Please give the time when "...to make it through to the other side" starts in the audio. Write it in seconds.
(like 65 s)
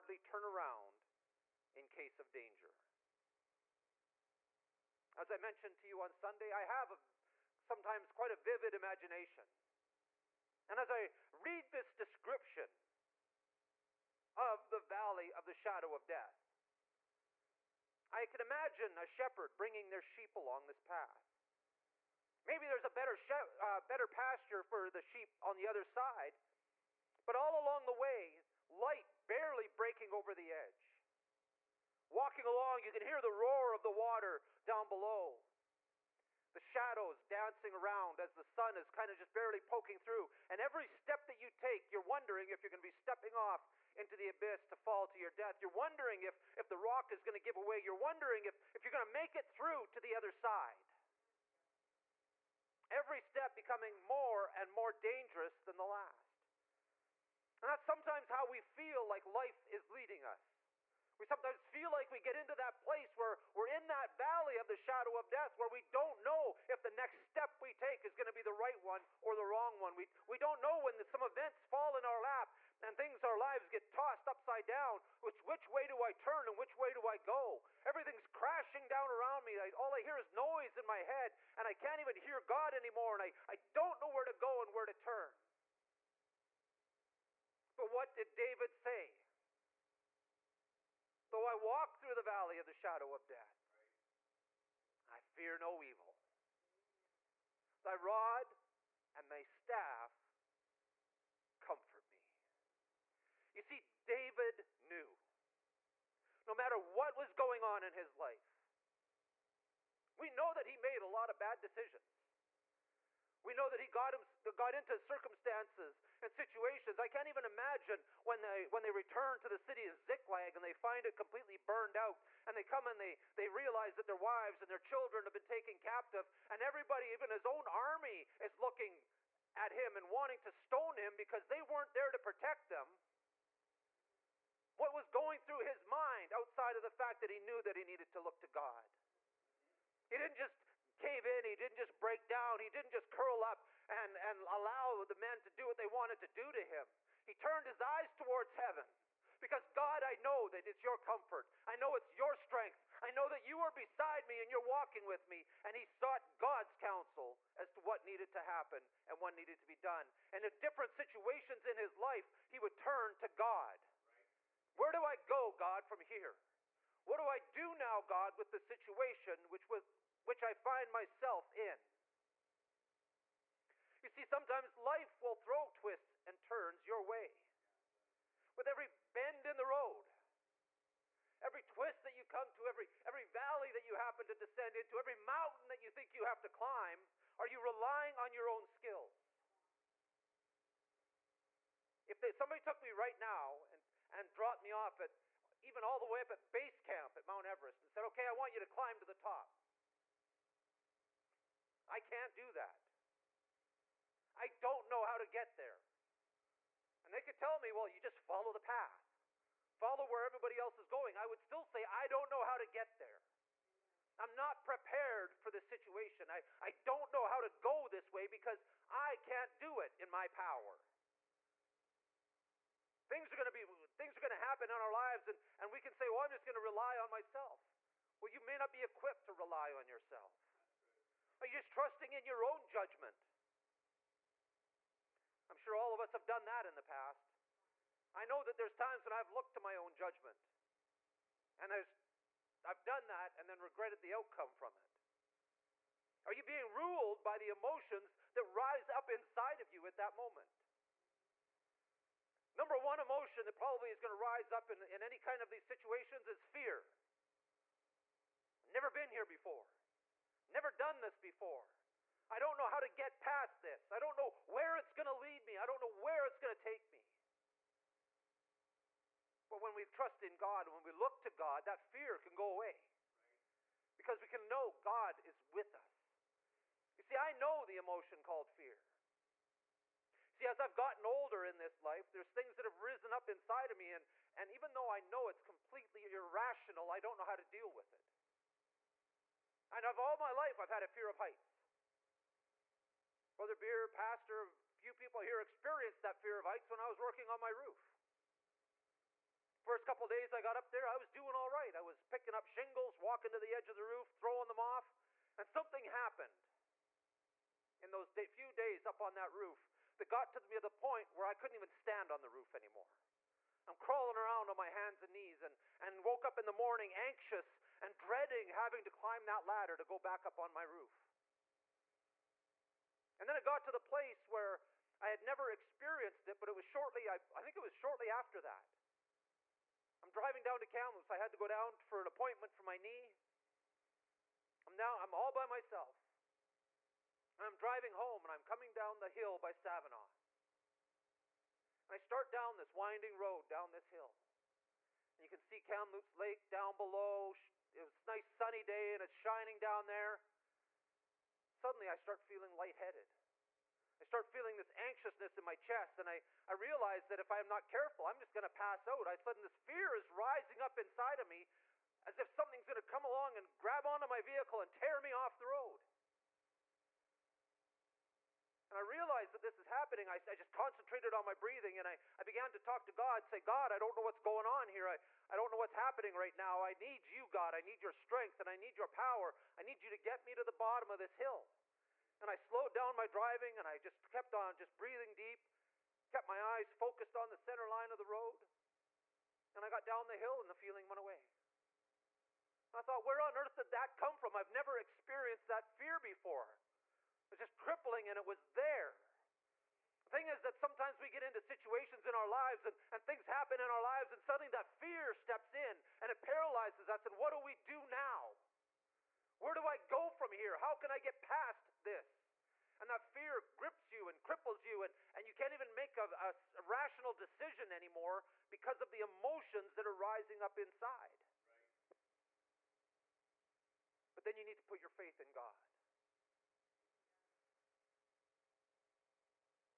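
49 s.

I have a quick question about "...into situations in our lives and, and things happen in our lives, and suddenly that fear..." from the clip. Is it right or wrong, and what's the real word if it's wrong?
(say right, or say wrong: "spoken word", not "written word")
right.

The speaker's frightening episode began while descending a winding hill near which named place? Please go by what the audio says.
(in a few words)
Savinoff.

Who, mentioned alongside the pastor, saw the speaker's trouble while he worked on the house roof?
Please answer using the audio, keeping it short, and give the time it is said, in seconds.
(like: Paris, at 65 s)
Brother Beer, at 293 s.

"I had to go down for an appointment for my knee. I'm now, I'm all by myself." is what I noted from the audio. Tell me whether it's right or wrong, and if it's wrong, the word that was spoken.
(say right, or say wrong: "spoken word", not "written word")
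right.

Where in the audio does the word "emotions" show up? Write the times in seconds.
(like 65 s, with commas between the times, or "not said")
247 s, 252 s, 277 s, 418 s.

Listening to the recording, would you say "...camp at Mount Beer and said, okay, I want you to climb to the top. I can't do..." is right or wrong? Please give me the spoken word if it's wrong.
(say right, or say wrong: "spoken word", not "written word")
wrong: "Everest", not "Beer".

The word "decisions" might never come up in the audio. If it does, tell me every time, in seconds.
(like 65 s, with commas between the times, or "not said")
111 s, 417 s.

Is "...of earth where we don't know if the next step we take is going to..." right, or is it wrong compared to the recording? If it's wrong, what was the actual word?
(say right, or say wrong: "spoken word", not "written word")
wrong: "death", not "earth".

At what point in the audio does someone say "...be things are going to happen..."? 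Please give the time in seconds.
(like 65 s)
223 s.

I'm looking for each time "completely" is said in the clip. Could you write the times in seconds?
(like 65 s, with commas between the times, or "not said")
121 s, 285 s.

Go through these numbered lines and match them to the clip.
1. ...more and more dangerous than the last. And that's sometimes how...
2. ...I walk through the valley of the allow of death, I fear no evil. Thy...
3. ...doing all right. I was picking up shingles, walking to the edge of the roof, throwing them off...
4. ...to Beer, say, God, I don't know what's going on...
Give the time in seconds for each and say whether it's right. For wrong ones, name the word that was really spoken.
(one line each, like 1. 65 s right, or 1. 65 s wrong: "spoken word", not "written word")
1. 54 s right
2. 91 s wrong: "shadow", not "allow"
3. 301 s right
4. 372 s wrong: "God", not "Beer".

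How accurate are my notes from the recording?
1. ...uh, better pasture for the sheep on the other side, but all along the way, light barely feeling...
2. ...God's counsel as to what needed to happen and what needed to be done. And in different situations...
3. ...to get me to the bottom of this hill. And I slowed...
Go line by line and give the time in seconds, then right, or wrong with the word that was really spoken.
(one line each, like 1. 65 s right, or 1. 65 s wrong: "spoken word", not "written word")
1. 23 s wrong: "breaking", not "feeling"
2. 156 s right
3. 379 s right.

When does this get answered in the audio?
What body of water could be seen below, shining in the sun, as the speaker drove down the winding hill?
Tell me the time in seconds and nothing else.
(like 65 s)
345 s.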